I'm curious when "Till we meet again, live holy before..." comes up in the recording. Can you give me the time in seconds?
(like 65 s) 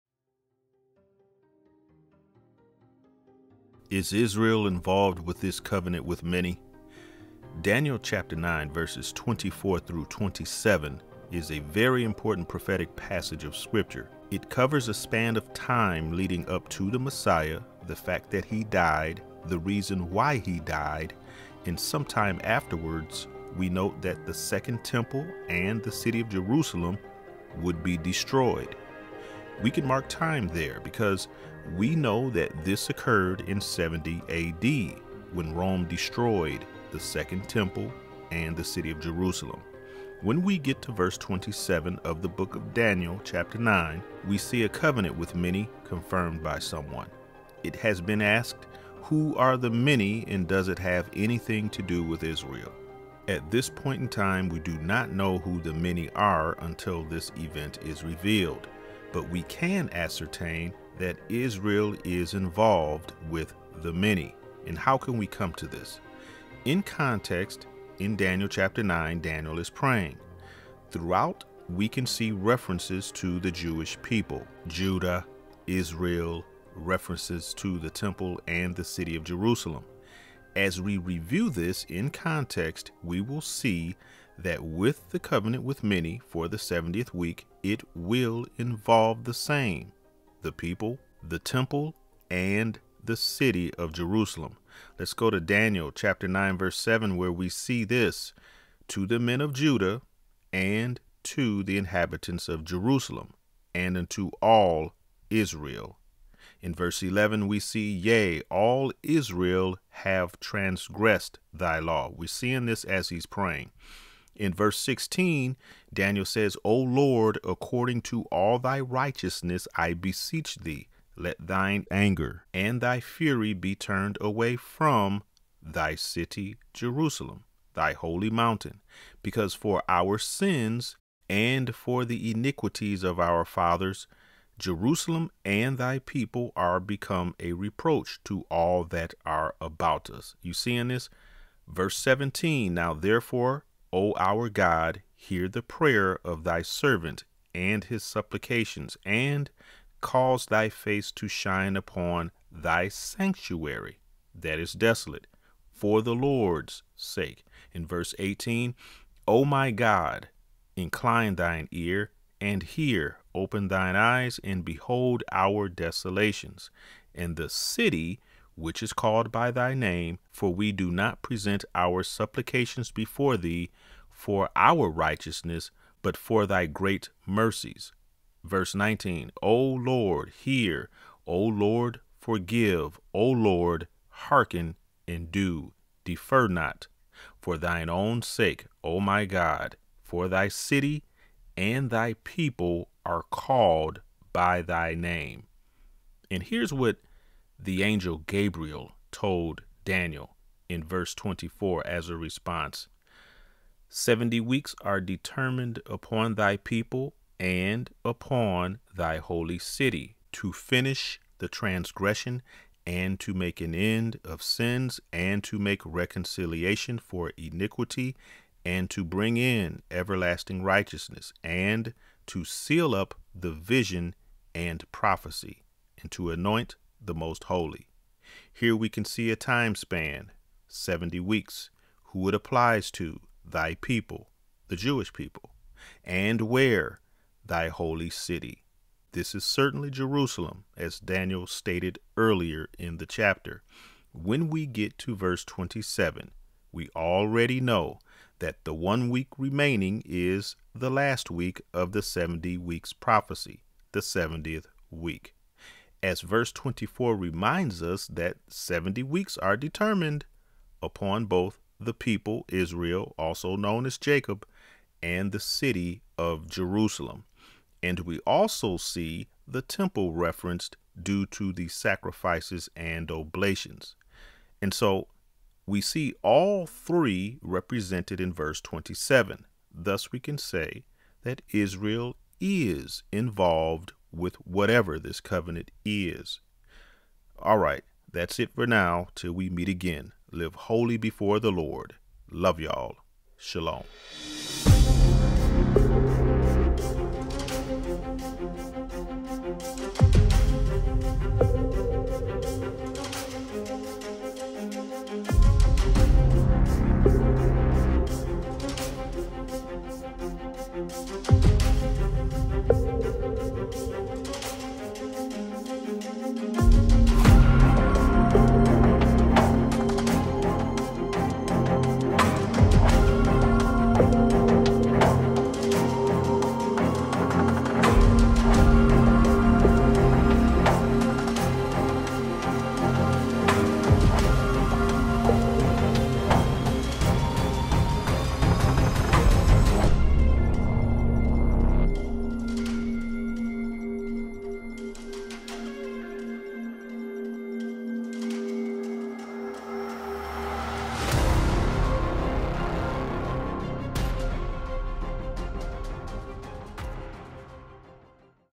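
289 s.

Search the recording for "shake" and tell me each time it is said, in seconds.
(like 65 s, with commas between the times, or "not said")
not said.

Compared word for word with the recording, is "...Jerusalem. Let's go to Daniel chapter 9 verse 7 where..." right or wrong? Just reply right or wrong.
right.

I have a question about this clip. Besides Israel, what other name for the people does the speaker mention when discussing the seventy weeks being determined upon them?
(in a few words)
Jacob.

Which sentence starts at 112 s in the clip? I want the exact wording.
We're seeing this as he's praying.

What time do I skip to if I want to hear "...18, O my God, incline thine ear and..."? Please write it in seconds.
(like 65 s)
158 s.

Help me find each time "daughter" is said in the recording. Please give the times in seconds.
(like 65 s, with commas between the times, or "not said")
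not said.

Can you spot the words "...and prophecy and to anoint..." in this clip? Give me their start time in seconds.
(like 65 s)
224 s.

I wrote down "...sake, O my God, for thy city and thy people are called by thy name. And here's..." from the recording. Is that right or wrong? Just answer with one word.
right.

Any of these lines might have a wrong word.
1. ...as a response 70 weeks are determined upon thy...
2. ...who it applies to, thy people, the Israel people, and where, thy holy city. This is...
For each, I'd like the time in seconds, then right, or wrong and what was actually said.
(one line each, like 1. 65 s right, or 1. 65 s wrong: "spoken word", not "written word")
1. 201 s right
2. 232 s wrong: "Jewish", not "Israel".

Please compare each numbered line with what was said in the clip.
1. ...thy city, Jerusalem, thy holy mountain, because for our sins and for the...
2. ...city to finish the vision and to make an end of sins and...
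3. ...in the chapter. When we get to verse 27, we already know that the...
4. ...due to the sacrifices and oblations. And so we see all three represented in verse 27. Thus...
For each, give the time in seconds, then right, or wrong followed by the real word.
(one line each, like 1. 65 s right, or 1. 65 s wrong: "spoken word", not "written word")
1. 125 s right
2. 209 s wrong: "transgression", not "vision"
3. 242 s right
4. 271 s right.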